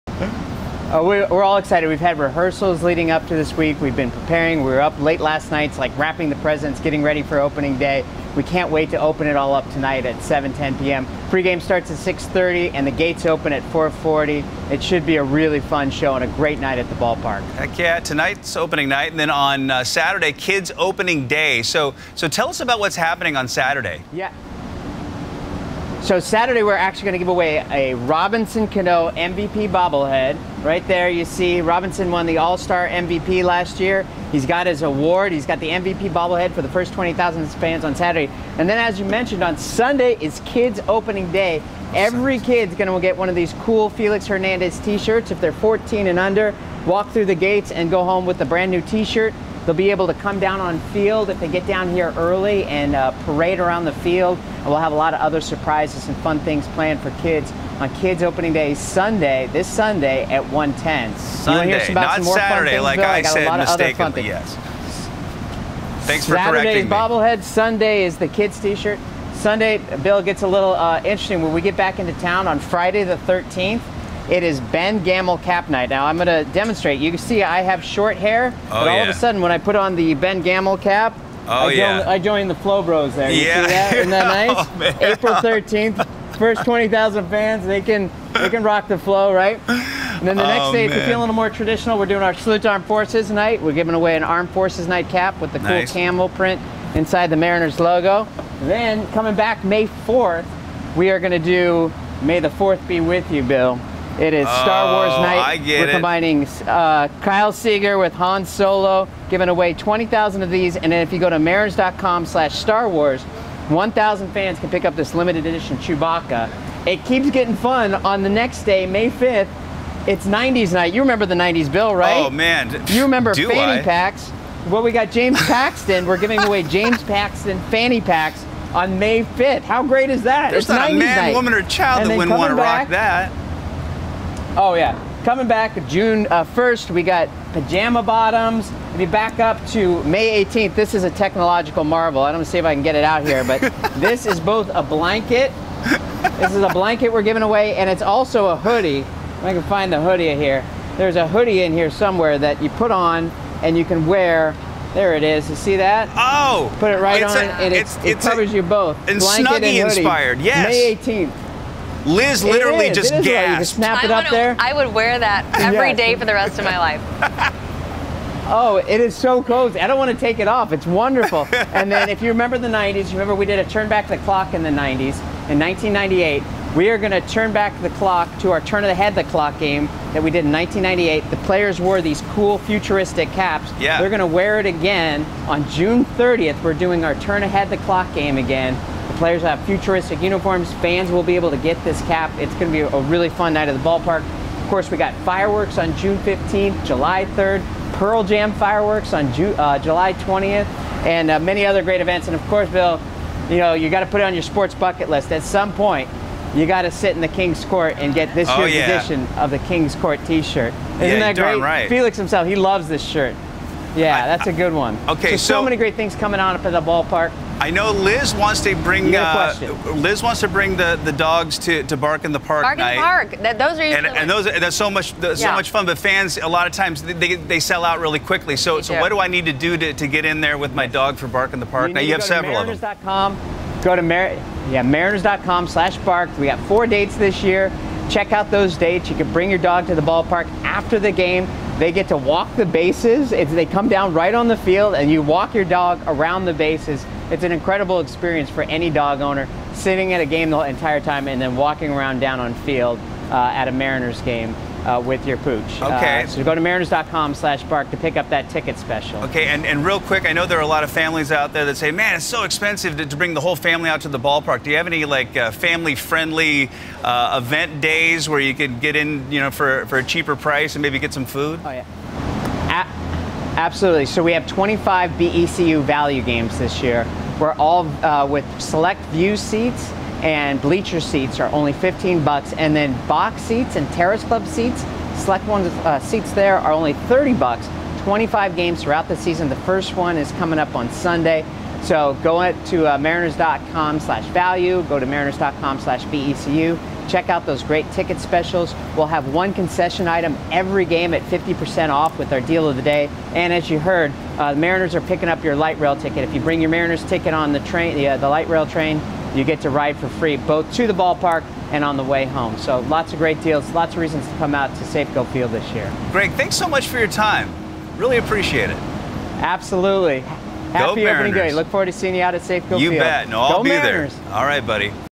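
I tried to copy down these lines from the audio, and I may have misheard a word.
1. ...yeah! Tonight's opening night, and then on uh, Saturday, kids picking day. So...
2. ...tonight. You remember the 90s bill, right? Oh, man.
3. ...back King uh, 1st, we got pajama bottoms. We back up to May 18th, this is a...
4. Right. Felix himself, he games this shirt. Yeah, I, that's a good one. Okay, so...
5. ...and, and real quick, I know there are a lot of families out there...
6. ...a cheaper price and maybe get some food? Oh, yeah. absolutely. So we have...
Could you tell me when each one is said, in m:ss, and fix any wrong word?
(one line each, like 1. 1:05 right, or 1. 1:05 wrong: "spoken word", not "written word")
1. 0:17 wrong: "opening", not "picking"
2. 2:00 wrong: "night", not "tonight"
3. 2:15 wrong: "June", not "King"
4. 3:31 wrong: "loves", not "games"
5. 4:19 right
6. 4:29 right.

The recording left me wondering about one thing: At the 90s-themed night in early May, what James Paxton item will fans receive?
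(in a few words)
Fanny packs.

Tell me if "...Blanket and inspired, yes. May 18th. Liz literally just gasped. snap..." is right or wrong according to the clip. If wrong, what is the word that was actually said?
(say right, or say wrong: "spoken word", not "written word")
right.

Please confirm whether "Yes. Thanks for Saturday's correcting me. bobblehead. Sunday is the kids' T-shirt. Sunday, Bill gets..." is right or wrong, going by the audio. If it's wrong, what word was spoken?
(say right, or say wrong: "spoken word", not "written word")
right.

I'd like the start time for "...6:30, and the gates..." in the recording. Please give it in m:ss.
0:11.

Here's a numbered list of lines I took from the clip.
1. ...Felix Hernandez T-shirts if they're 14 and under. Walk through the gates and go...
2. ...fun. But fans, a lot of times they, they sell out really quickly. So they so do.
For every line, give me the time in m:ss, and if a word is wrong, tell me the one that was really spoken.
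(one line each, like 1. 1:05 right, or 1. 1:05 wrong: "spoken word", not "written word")
1. 0:43 right
2. 3:45 right.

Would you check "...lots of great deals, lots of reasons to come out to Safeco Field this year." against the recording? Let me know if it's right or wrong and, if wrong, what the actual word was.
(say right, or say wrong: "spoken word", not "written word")
right.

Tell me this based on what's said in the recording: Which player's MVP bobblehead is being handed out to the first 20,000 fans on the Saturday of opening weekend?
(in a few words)
Robinson Cano.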